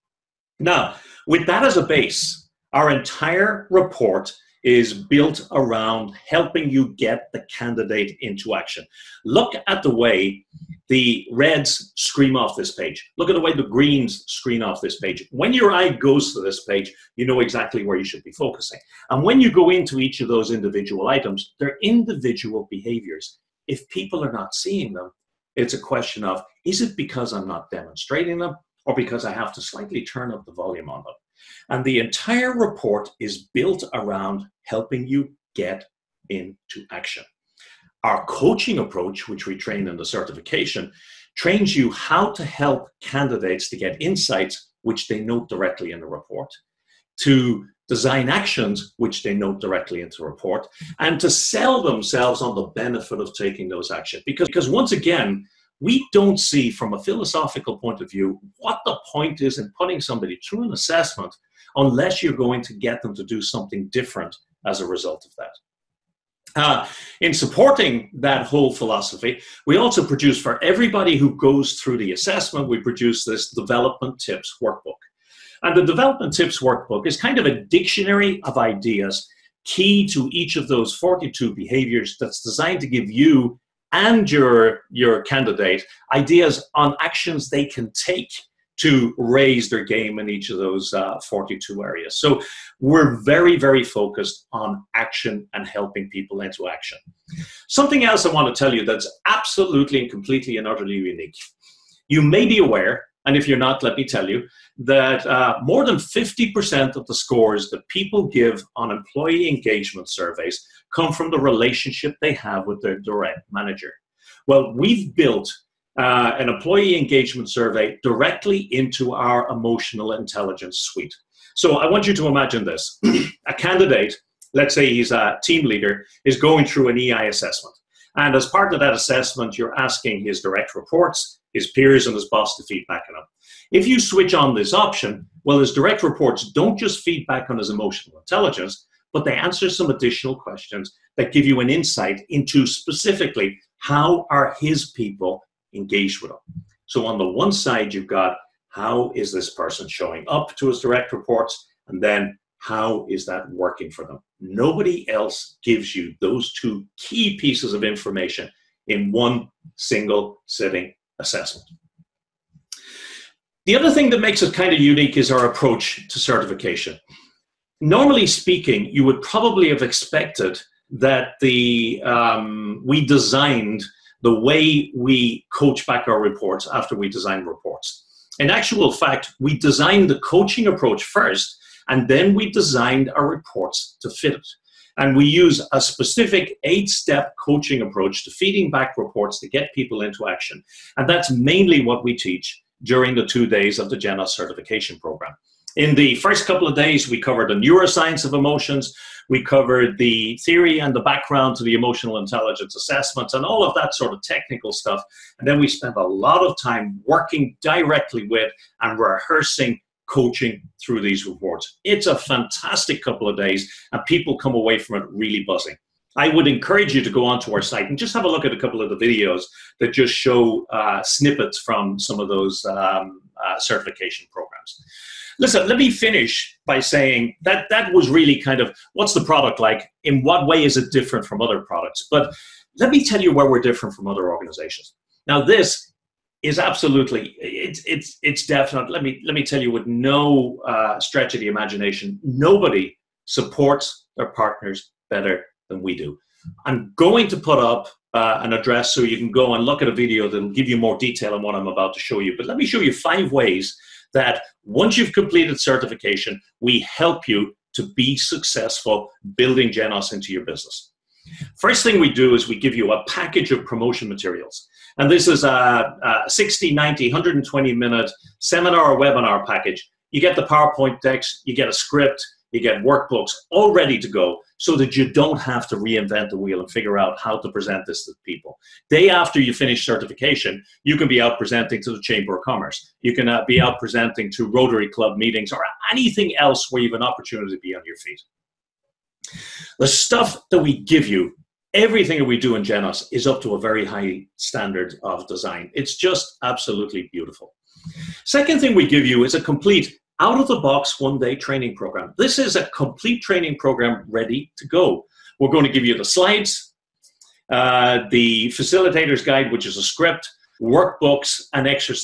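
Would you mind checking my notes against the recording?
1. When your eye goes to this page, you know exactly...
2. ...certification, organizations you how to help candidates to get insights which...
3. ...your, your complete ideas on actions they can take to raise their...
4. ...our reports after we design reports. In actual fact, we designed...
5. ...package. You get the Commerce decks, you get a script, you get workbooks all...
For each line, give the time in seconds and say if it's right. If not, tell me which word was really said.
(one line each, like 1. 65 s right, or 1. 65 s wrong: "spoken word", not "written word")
1. 15 s right
2. 40 s wrong: "trains", not "organizations"
3. 84 s wrong: "candidate", not "complete"
4. 176 s right
5. 269 s wrong: "PowerPoint", not "Commerce".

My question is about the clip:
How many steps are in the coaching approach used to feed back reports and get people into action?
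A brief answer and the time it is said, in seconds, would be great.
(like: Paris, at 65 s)
eight, at 186 s.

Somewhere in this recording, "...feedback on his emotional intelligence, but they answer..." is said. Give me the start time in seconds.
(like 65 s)
137 s.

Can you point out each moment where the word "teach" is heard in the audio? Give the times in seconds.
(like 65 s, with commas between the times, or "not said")
192 s.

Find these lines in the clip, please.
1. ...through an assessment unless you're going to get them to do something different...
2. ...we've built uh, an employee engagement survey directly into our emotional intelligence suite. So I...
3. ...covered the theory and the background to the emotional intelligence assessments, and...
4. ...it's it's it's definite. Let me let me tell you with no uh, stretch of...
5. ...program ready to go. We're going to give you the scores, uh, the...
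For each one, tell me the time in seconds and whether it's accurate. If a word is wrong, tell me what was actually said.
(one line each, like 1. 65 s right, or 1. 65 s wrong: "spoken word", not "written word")
1. 60 s right
2. 114 s right
3. 199 s right
4. 237 s right
5. 303 s wrong: "slides", not "scores".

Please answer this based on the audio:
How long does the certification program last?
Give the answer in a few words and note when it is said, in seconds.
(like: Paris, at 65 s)
two days, at 193 s.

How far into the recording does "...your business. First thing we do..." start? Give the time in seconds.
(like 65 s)
260 s.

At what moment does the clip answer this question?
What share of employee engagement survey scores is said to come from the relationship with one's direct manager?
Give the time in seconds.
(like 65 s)
105 s.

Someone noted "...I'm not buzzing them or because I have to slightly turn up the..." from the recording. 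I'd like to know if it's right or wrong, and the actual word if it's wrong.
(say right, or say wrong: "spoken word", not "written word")
wrong: "demonstrating", not "buzzing".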